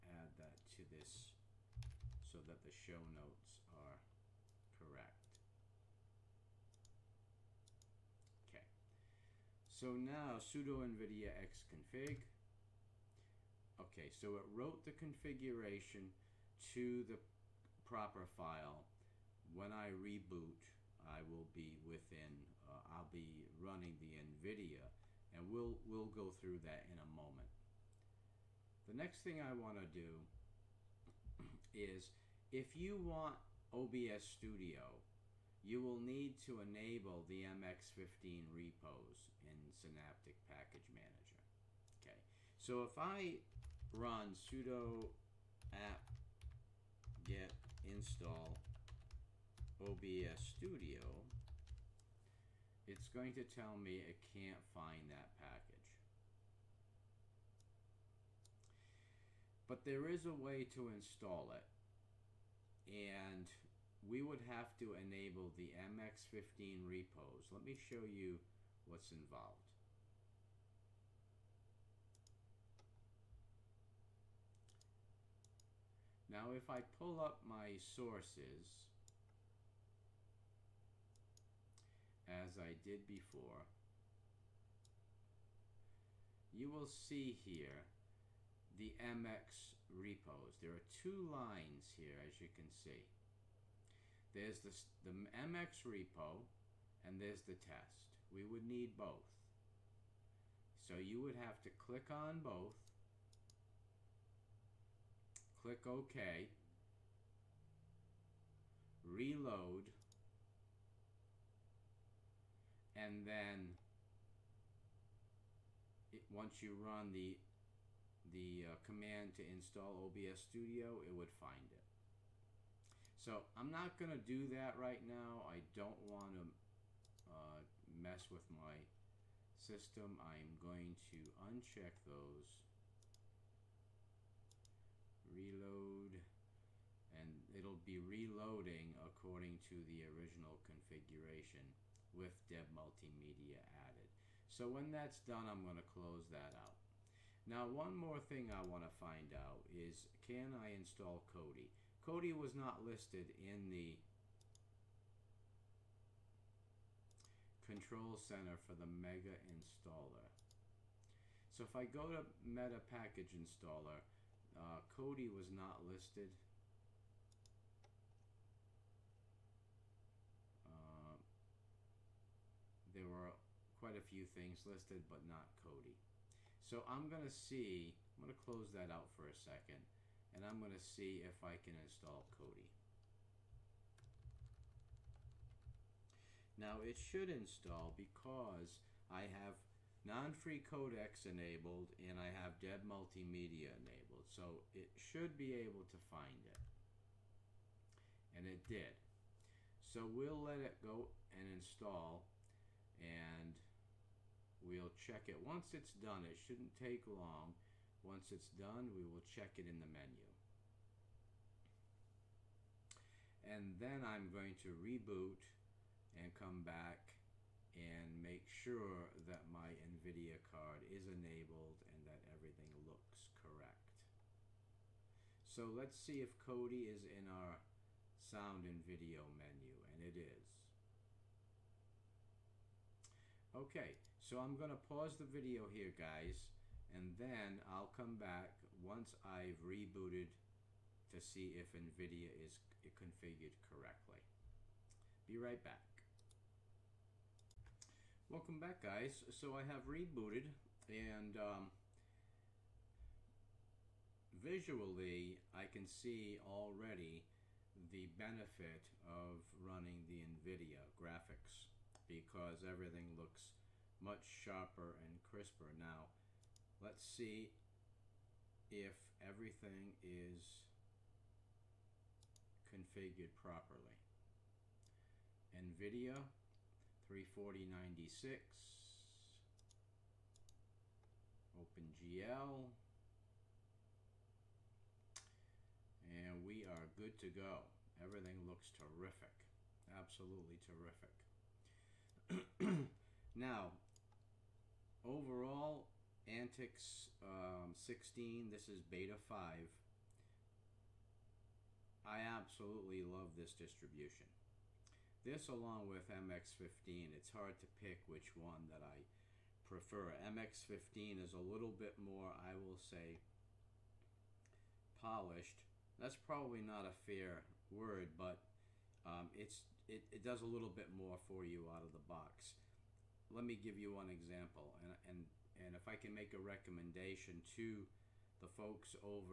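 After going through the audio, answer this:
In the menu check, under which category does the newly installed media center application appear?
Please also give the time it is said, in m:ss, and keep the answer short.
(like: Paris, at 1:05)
sound and video, at 3:48.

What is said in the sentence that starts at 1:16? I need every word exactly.
Now if I pull up my sources, as I did before, you will see here the MX repos.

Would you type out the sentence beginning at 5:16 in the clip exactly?
That's probably not a fair word, but um, it's it, it does a little bit more for you out of the box.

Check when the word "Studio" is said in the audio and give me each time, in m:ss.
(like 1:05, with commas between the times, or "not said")
0:34, 0:50, 2:00.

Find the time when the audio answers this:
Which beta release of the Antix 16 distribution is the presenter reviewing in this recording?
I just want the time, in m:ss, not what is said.
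4:58.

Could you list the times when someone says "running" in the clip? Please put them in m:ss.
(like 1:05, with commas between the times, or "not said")
0:23, 4:19.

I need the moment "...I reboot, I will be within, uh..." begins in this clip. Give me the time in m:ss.
0:19.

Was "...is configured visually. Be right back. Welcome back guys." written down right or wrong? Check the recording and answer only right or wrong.
wrong.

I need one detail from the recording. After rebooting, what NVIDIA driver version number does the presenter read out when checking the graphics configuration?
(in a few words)
340.96.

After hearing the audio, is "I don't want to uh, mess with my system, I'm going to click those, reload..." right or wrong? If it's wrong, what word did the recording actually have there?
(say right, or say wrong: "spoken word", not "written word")
wrong: "uncheck", not "click".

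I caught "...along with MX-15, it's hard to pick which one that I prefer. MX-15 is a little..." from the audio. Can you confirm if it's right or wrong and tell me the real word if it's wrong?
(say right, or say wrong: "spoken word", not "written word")
right.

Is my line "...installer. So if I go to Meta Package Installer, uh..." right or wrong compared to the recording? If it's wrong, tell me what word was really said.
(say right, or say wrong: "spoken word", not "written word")
right.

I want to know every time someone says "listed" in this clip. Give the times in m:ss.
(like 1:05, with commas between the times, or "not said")
2:32, 2:45, 2:54.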